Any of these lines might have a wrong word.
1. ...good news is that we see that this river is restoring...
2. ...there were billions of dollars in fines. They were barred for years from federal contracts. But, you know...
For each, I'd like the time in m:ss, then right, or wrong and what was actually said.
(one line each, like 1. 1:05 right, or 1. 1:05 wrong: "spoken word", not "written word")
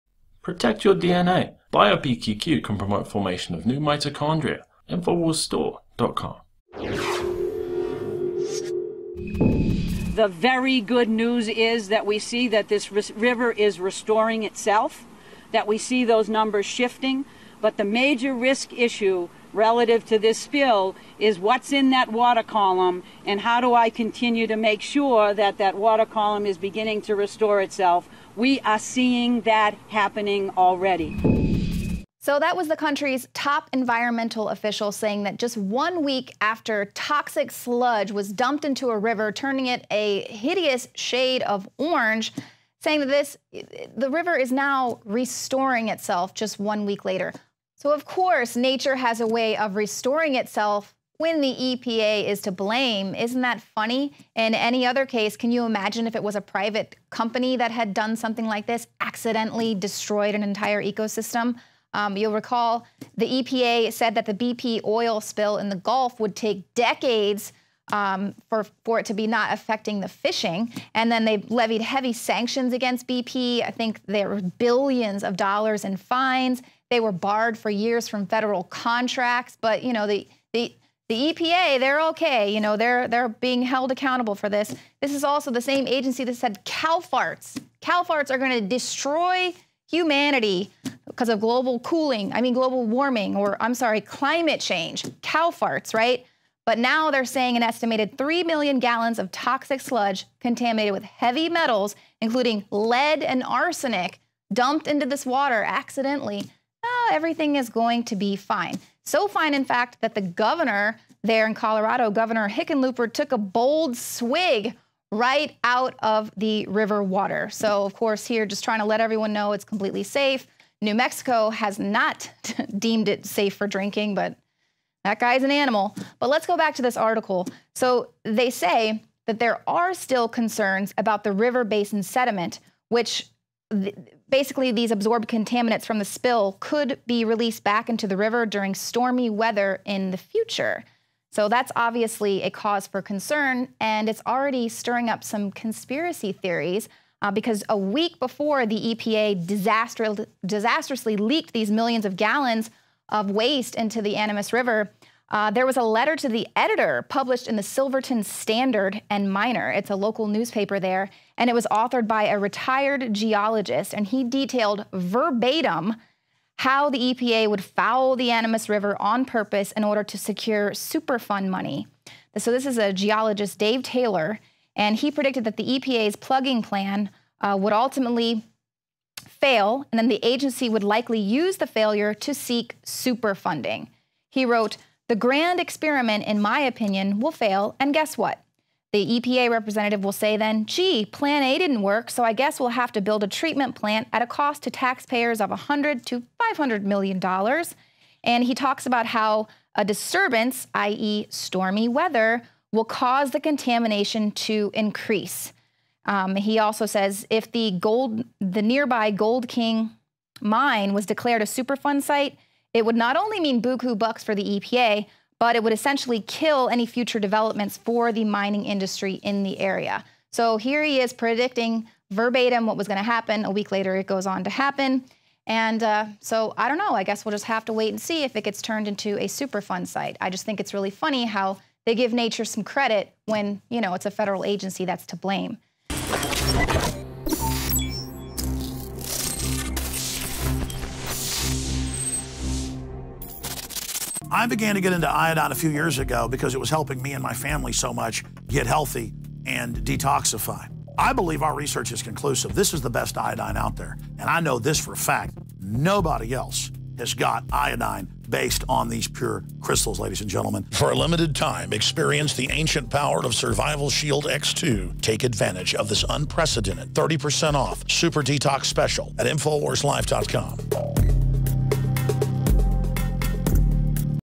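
1. 0:10 right
2. 1:14 right.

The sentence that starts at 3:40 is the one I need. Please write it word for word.
So here he is predicting verbatim what was going to happen.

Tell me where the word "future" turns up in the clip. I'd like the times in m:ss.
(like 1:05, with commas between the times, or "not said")
2:20, 3:36.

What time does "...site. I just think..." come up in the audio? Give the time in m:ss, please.
3:49.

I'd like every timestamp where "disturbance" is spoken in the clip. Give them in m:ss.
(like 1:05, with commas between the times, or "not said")
3:19.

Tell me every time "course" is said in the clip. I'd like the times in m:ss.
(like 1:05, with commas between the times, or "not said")
0:48, 1:57.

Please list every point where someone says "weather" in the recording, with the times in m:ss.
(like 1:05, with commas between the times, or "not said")
2:19, 3:21.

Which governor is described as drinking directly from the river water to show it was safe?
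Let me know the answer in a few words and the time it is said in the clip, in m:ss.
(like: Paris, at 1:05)
Governor Hickenlooper, at 1:52.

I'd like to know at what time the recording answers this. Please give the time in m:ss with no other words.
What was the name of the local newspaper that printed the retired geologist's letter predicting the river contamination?
2:37.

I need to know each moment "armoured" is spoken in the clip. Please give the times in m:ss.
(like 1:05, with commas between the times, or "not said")
not said.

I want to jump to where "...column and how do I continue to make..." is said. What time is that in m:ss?
0:22.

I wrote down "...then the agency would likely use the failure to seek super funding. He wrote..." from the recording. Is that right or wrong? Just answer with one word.
right.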